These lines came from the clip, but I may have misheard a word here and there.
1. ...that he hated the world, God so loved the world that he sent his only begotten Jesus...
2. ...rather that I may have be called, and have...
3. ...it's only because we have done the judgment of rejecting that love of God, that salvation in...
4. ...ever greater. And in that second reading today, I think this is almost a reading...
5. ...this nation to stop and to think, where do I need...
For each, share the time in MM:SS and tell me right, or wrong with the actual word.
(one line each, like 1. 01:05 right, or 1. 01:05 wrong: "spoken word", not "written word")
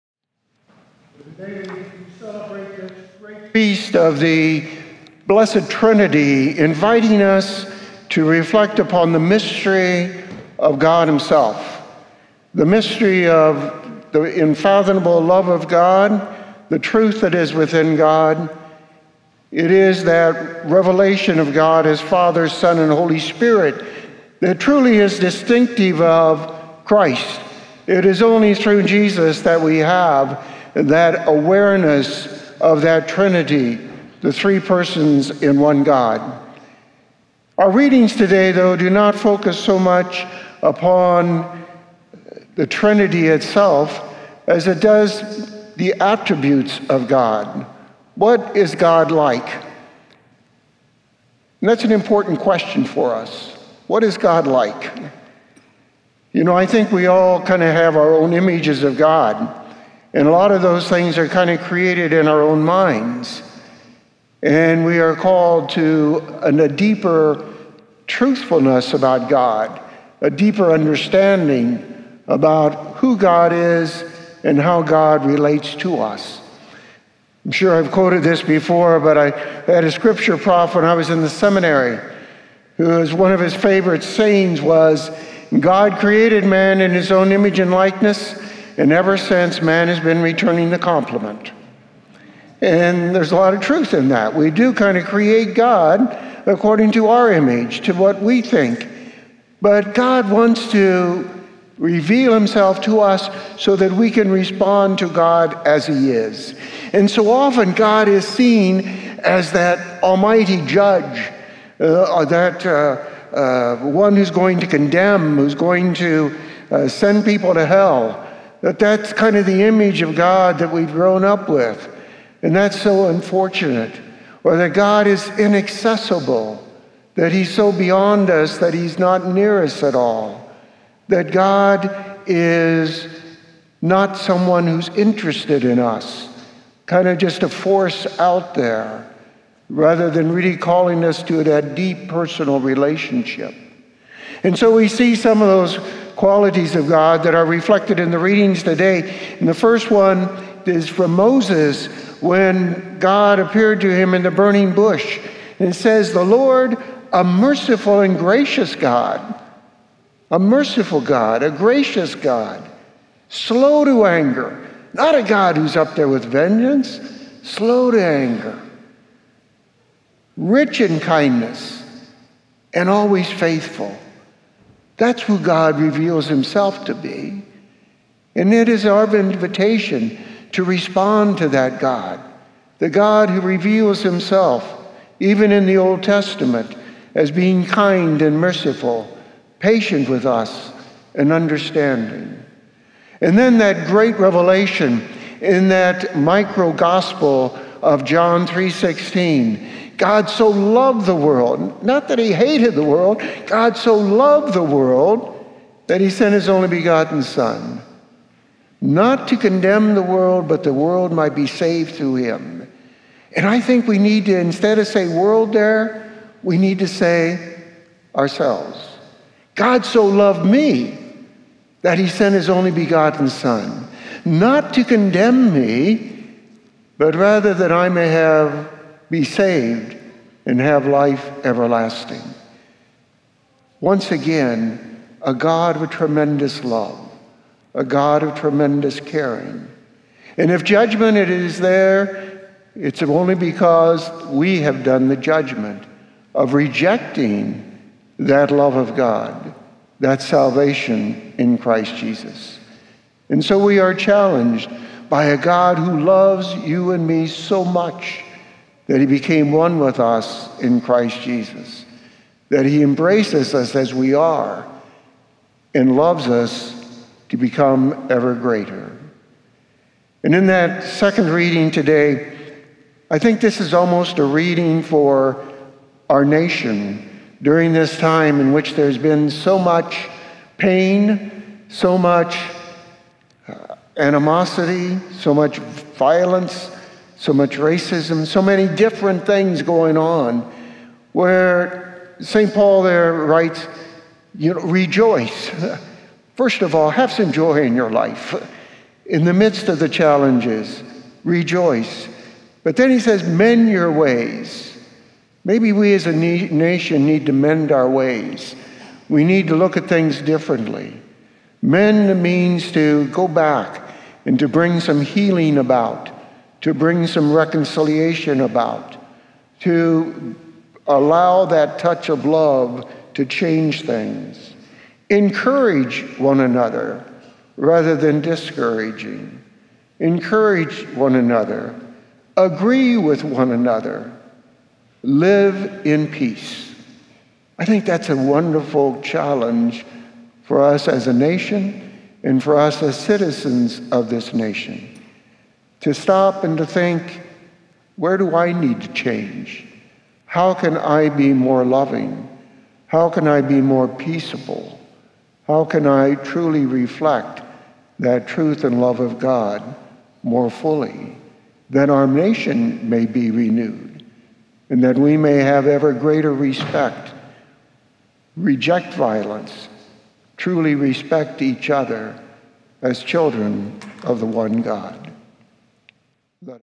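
1. 03:22 wrong: "Son", not "Jesus"
2. 03:47 wrong: "saved", not "called"
3. 04:02 right
4. 04:28 right
5. 05:44 right.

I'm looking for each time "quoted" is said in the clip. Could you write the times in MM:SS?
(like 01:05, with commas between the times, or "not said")
01:17.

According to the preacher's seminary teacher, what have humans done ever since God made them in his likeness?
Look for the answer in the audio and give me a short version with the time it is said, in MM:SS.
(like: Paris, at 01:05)
Returning the compliment, at 01:30.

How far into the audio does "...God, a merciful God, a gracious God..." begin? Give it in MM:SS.
02:38.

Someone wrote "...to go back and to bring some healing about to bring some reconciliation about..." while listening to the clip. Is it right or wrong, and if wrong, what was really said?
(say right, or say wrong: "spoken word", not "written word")
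right.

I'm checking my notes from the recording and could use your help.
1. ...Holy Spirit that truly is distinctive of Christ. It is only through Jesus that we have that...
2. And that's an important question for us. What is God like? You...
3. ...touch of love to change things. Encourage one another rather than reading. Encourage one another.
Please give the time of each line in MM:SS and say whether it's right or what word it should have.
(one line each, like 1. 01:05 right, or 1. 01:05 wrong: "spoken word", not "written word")
1. 00:22 right
2. 00:51 right
3. 05:21 wrong: "discouraging", not "reading".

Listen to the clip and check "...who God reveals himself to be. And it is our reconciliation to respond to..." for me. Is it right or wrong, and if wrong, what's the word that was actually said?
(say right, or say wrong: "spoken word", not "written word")
wrong: "invitation", not "reconciliation".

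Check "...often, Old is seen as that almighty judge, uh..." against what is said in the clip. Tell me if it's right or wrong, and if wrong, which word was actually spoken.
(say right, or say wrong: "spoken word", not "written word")
wrong: "God", not "Old".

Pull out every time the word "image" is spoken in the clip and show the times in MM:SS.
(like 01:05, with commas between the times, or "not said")
00:58, 01:27, 01:37, 01:59.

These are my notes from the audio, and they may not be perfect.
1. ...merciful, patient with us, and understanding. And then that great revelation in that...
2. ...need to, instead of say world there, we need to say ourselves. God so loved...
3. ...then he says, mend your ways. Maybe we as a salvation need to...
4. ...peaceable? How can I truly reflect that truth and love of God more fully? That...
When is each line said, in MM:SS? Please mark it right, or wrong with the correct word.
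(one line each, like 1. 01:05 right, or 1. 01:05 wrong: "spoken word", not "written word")
1. 03:08 right
2. 03:33 right
3. 05:02 wrong: "nation", not "salvation"
4. 05:53 right.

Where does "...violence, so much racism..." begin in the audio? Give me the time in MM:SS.
04:45.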